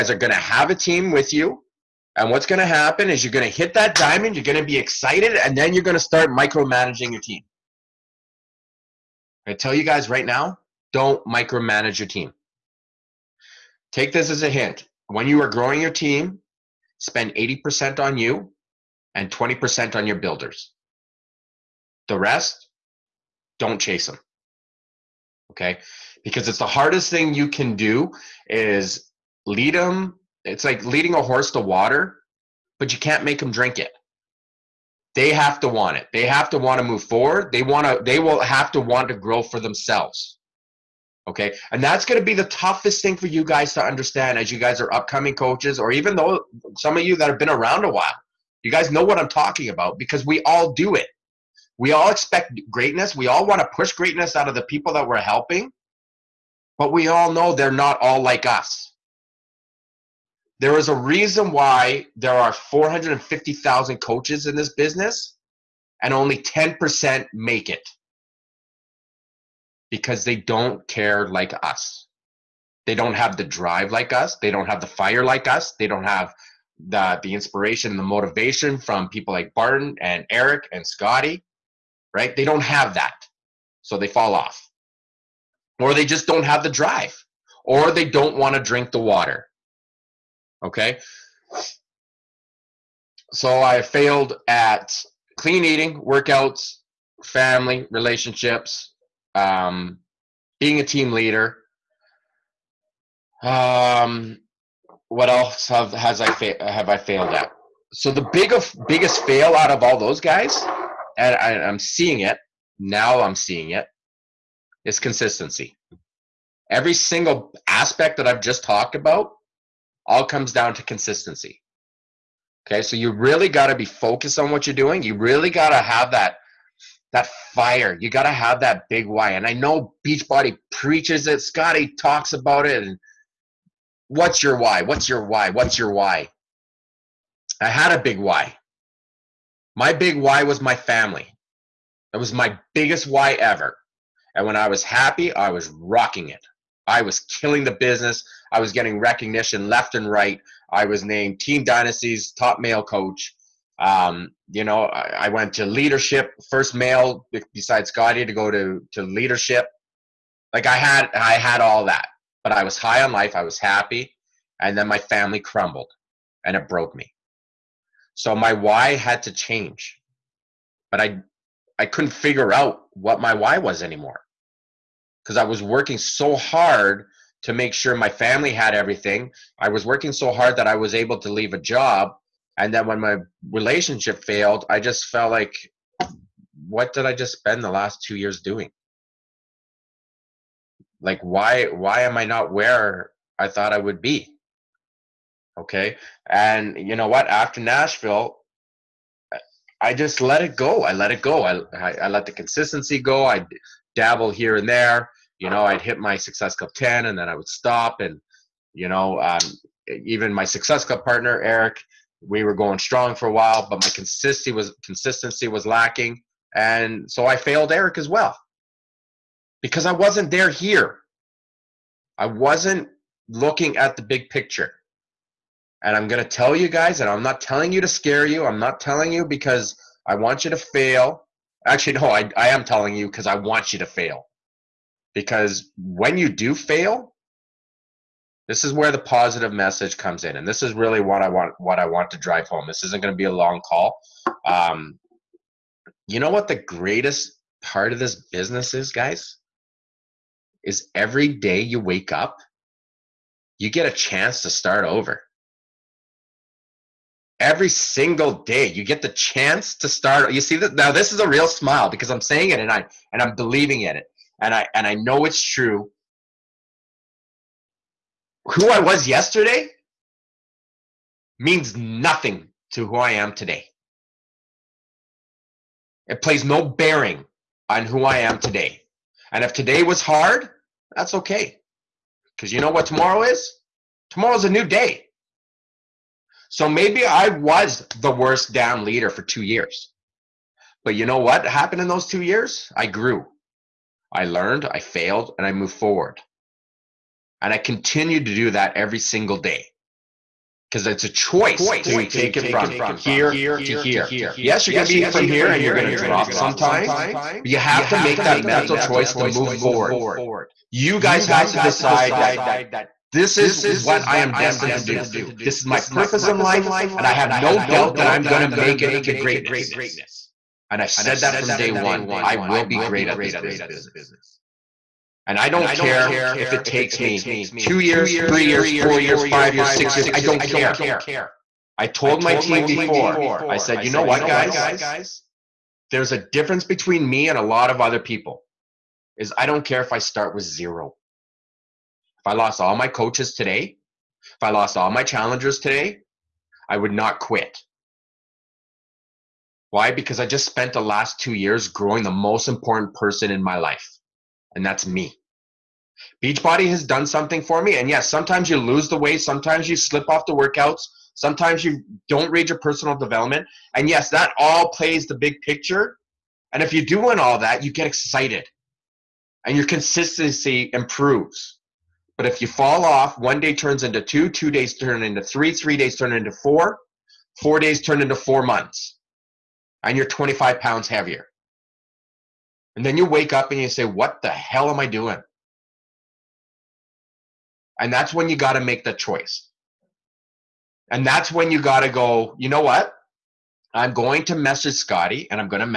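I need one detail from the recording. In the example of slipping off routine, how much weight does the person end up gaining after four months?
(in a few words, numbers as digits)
25 pounds.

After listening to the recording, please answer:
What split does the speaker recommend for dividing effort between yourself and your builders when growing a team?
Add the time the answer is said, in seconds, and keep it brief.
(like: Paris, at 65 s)
80% on you, 20% on builders, at 17 s.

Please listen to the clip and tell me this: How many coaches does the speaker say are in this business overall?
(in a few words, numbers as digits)
450,000.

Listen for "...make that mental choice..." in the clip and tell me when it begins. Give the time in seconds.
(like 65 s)
307 s.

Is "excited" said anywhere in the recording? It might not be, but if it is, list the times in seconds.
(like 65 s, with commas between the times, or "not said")
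4 s, 367 s.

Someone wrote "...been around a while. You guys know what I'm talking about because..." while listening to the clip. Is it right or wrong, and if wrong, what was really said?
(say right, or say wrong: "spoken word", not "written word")
right.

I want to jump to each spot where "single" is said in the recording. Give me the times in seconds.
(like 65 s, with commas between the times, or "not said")
116 s, 257 s, 298 s.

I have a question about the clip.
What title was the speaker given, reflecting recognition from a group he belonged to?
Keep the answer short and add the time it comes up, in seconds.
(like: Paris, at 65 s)
Team Dynasty's top male coach, at 151 s.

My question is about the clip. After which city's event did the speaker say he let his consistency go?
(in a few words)
Nashville.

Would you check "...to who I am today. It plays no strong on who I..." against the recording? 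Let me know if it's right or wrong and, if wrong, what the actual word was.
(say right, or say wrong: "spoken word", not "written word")
wrong: "bearing", not "strong".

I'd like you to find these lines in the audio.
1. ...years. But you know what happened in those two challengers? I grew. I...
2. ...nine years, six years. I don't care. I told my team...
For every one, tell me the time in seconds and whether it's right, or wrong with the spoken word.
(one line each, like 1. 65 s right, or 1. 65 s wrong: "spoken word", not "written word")
1. 289 s wrong: "years", not "challengers"
2. 329 s wrong: "five", not "nine".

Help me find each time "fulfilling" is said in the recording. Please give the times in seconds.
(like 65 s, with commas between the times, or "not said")
not said.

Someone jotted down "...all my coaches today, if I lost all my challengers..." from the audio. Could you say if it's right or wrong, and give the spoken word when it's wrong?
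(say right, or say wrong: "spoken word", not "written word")
right.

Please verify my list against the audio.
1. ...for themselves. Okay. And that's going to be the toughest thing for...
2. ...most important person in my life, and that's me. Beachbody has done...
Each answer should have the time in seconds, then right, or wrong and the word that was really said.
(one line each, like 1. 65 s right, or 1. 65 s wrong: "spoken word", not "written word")
1. 39 s right
2. 352 s right.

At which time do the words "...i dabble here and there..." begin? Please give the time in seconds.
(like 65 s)
203 s.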